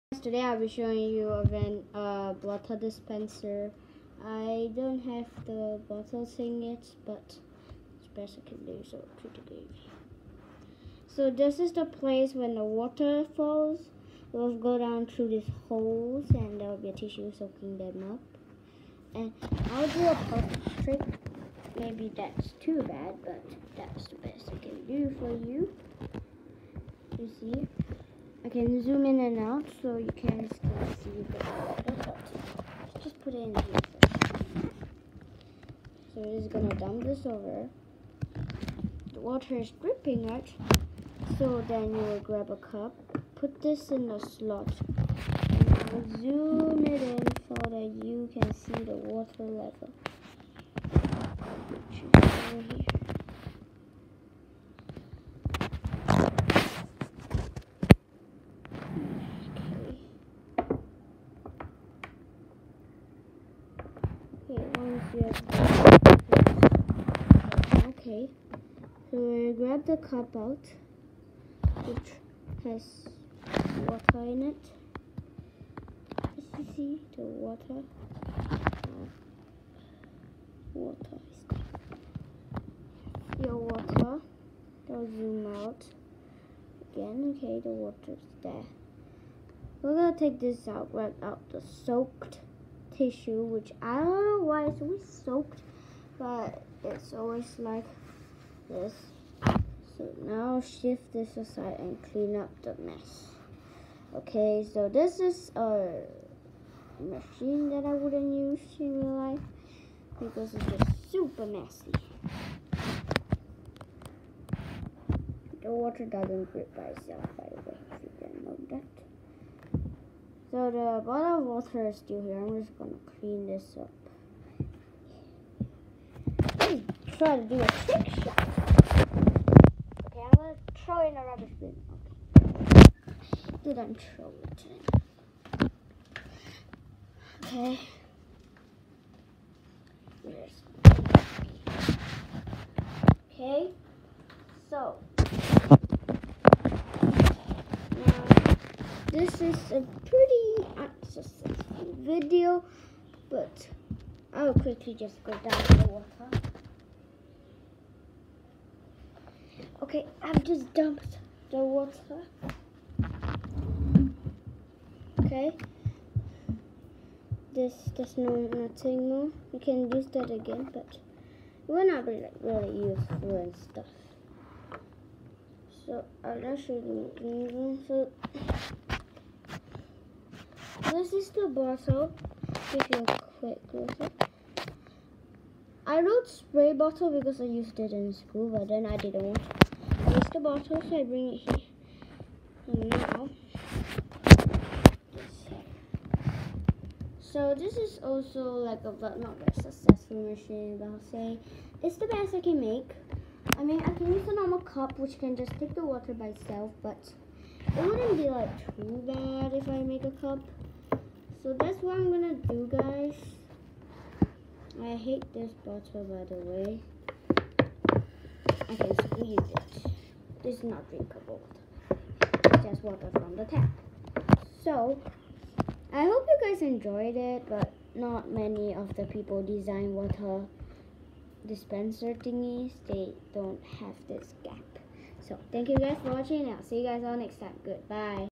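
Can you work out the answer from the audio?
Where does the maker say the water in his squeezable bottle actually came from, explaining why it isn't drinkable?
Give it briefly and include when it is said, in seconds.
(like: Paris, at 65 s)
the tap, at 223 s.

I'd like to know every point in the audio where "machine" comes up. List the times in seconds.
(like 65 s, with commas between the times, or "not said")
106 s, 200 s.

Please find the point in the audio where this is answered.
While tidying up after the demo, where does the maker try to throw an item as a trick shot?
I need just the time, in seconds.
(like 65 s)
131 s.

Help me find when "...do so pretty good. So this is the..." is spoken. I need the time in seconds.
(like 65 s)
8 s.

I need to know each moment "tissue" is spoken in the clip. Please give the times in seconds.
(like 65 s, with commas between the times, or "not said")
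16 s, 93 s.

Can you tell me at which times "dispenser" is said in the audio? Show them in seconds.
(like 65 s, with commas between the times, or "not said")
2 s, 231 s.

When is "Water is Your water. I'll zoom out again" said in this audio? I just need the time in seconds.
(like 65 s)
80 s.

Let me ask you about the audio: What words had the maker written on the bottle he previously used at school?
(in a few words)
spray bottle.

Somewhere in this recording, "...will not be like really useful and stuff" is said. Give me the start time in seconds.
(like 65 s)
171 s.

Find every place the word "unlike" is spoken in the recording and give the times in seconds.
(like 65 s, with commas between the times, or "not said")
not said.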